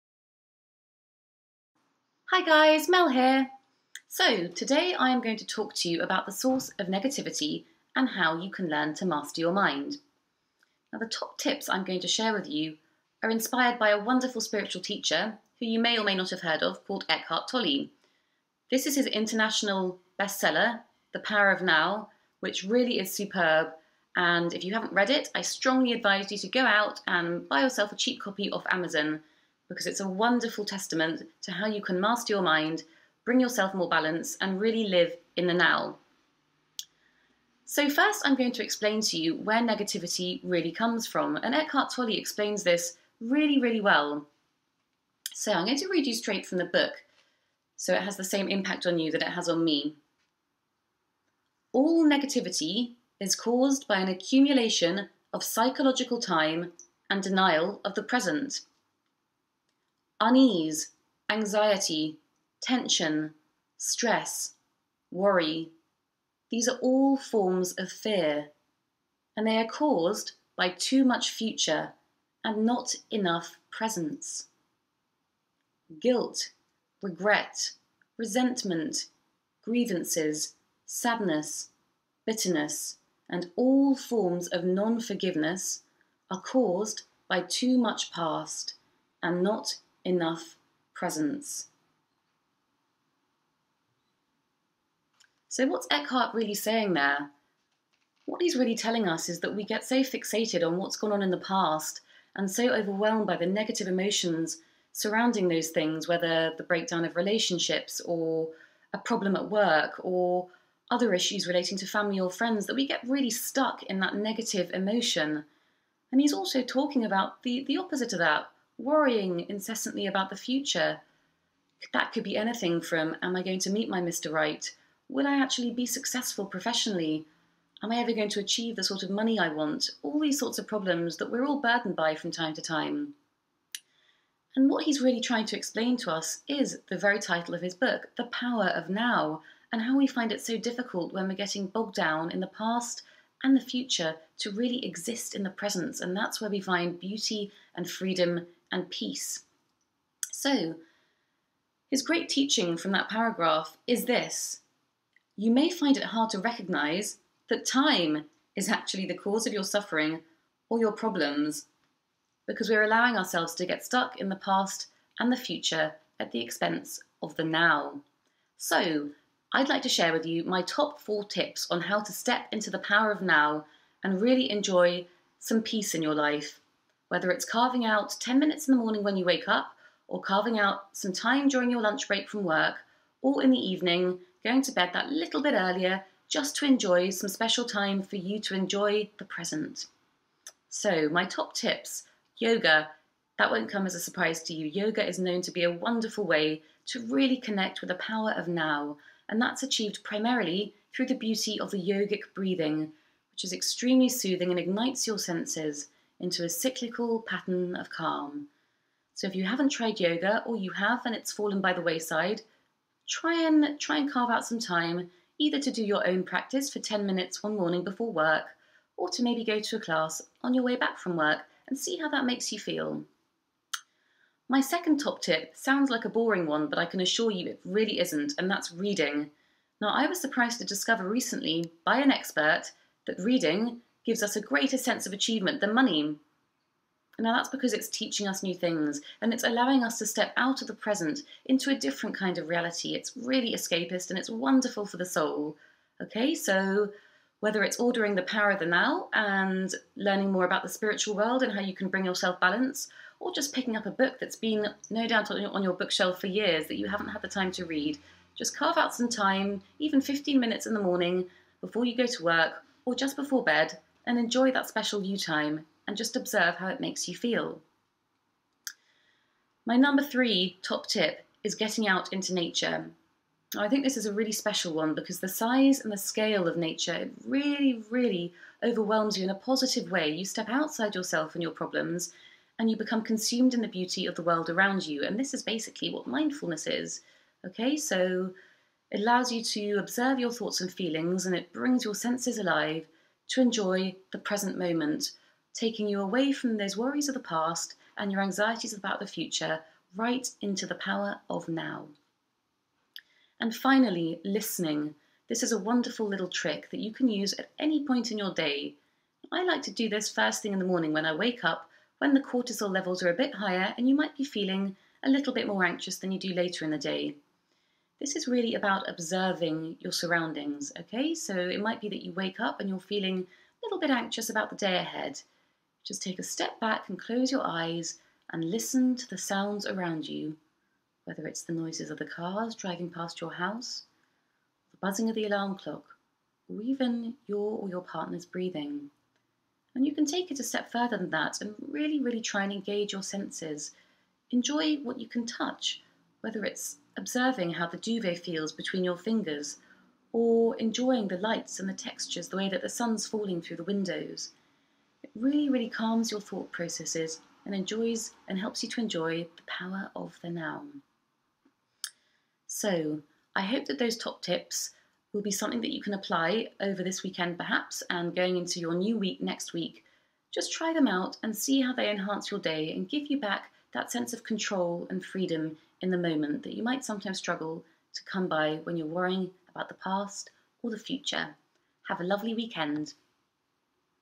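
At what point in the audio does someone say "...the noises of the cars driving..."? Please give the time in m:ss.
5:31.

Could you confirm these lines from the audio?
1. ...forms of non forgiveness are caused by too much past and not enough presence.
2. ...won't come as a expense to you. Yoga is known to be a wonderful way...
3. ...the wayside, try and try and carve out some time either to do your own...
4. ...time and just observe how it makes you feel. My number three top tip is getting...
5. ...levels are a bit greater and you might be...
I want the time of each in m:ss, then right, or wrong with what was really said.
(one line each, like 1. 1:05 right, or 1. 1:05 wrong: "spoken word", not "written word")
1. 1:23 right
2. 3:13 wrong: "surprise", not "expense"
3. 3:31 right
4. 4:25 right
5. 5:12 wrong: "higher", not "greater".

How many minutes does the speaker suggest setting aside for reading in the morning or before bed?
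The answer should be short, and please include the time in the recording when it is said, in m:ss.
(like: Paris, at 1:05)
15, at 4:20.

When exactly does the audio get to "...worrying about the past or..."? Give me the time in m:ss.
6:18.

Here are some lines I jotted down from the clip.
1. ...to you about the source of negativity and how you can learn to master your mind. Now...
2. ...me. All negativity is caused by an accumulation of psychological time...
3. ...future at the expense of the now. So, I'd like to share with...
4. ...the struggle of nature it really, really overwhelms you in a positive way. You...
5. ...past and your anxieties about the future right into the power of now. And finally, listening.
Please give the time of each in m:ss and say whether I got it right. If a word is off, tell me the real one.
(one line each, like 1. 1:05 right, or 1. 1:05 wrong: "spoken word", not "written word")
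1. 0:05 right
2. 0:49 right
3. 2:45 right
4. 4:35 wrong: "scale", not "struggle"
5. 4:57 right.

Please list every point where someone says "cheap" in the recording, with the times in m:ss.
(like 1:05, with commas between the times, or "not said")
0:27.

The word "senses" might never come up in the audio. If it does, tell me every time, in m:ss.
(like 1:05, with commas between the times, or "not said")
3:25, 3:54, 4:51, 5:43, 6:13.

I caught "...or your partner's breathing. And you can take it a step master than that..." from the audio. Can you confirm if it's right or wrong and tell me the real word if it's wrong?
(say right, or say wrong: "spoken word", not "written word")
wrong: "further", not "master".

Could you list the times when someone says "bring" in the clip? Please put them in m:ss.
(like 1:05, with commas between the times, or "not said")
0:33, 4:11, 4:51.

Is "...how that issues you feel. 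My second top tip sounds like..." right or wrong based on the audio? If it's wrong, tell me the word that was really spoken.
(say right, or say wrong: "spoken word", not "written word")
wrong: "makes", not "issues".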